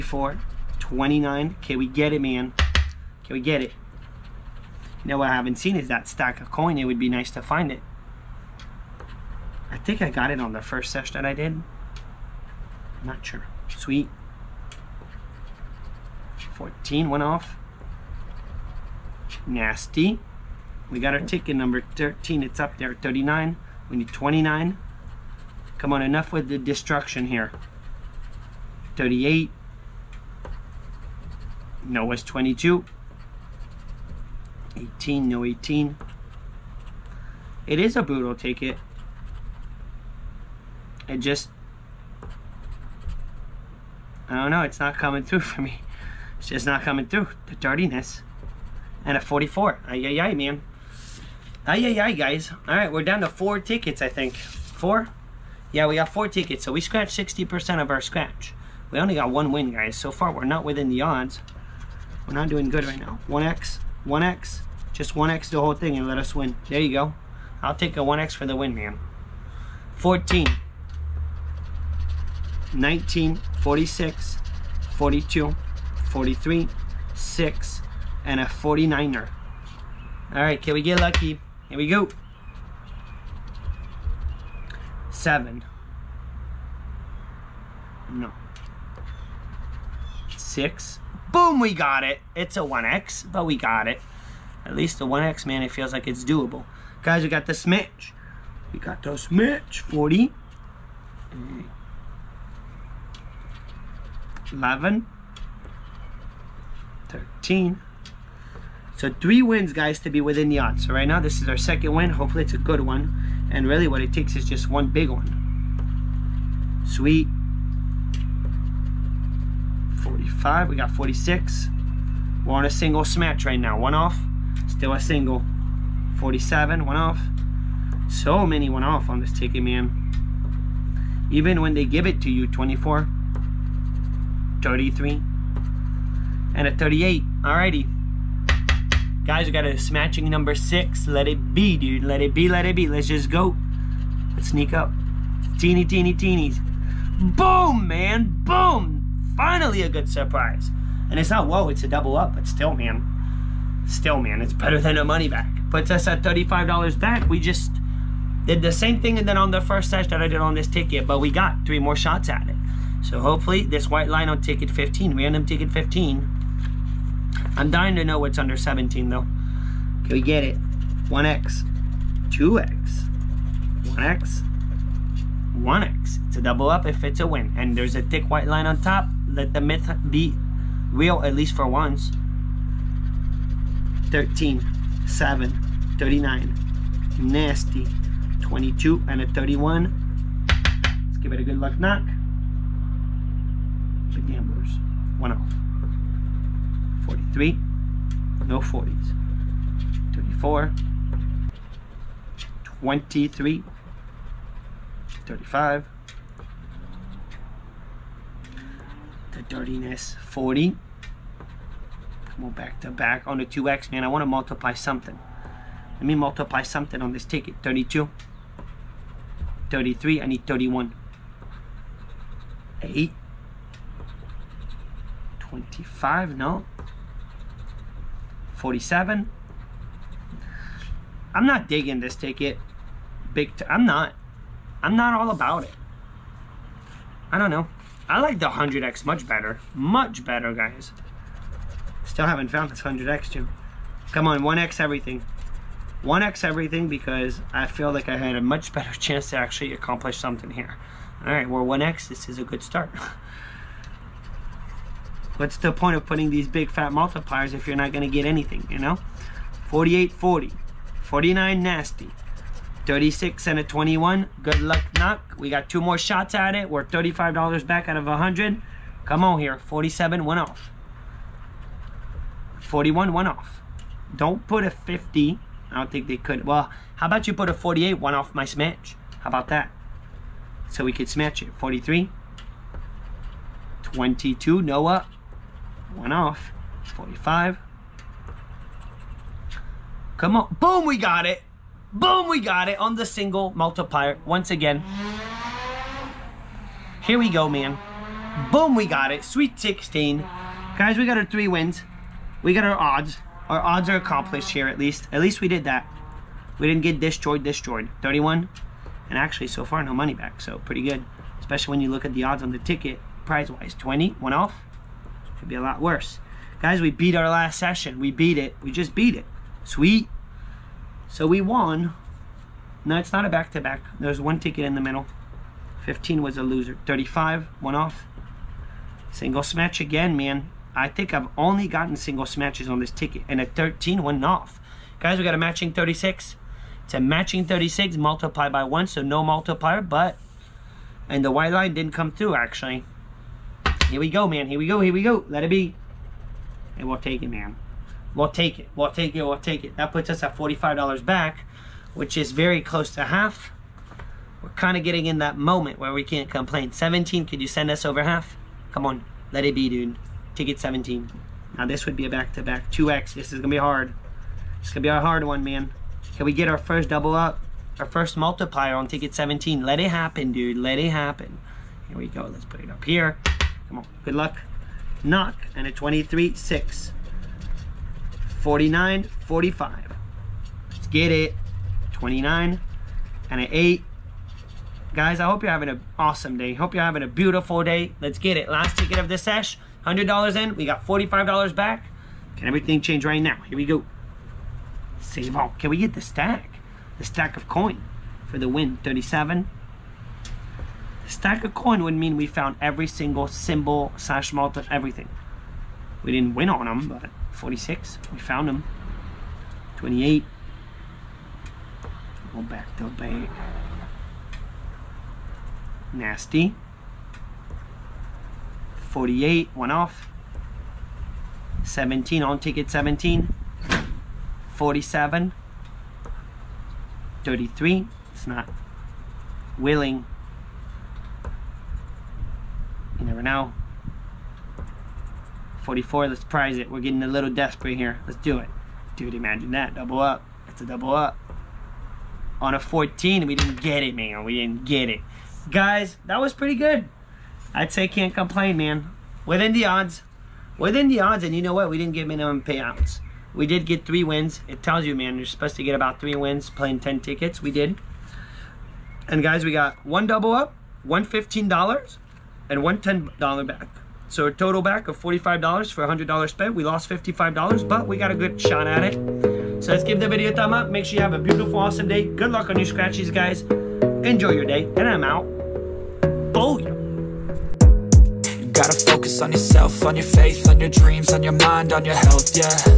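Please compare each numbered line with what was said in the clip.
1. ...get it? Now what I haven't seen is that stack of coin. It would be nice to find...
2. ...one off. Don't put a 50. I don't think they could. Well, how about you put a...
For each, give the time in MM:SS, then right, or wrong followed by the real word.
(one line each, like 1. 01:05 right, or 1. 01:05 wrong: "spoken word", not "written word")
1. 00:03 right
2. 04:33 right.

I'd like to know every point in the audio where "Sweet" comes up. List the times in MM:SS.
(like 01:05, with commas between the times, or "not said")
00:13, 01:56, 04:59, 05:19.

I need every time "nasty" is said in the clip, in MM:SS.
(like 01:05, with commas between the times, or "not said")
00:19, 03:07, 04:21.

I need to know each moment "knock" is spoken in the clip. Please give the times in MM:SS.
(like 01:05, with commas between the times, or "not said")
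03:11, 04:24, 06:15.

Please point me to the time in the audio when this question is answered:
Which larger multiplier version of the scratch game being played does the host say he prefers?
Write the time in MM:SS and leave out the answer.
03:58.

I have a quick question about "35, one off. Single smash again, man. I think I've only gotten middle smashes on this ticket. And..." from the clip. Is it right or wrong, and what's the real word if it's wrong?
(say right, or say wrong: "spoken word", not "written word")
wrong: "single", not "middle".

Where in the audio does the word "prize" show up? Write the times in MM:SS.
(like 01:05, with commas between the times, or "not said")
05:13, 07:16.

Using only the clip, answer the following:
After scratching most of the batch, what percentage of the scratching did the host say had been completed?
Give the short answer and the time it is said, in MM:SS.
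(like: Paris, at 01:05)
60%, at 00:57.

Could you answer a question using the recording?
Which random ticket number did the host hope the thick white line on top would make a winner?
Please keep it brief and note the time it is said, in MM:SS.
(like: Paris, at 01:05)
15, at 02:45.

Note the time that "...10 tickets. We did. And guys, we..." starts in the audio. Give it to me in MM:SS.
07:36.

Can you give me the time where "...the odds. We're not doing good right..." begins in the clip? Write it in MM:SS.
01:00.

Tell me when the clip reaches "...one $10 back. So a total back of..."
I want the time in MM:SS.
07:42.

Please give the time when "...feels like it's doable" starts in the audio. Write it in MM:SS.
01:35.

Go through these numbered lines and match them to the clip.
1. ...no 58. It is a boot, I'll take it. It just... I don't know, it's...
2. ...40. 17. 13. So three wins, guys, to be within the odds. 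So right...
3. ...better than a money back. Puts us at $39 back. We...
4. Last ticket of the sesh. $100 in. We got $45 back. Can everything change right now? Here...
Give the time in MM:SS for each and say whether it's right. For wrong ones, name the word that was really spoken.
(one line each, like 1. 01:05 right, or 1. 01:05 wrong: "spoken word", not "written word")
1. 00:35 wrong: "18", not "58"
2. 01:39 wrong: "11", not "17"
3. 02:34 wrong: "35", not "39"
4. 06:28 right.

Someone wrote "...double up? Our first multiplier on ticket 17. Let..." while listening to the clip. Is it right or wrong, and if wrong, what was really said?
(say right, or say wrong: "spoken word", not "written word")
right.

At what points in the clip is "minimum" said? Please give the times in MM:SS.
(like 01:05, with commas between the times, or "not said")
07:32.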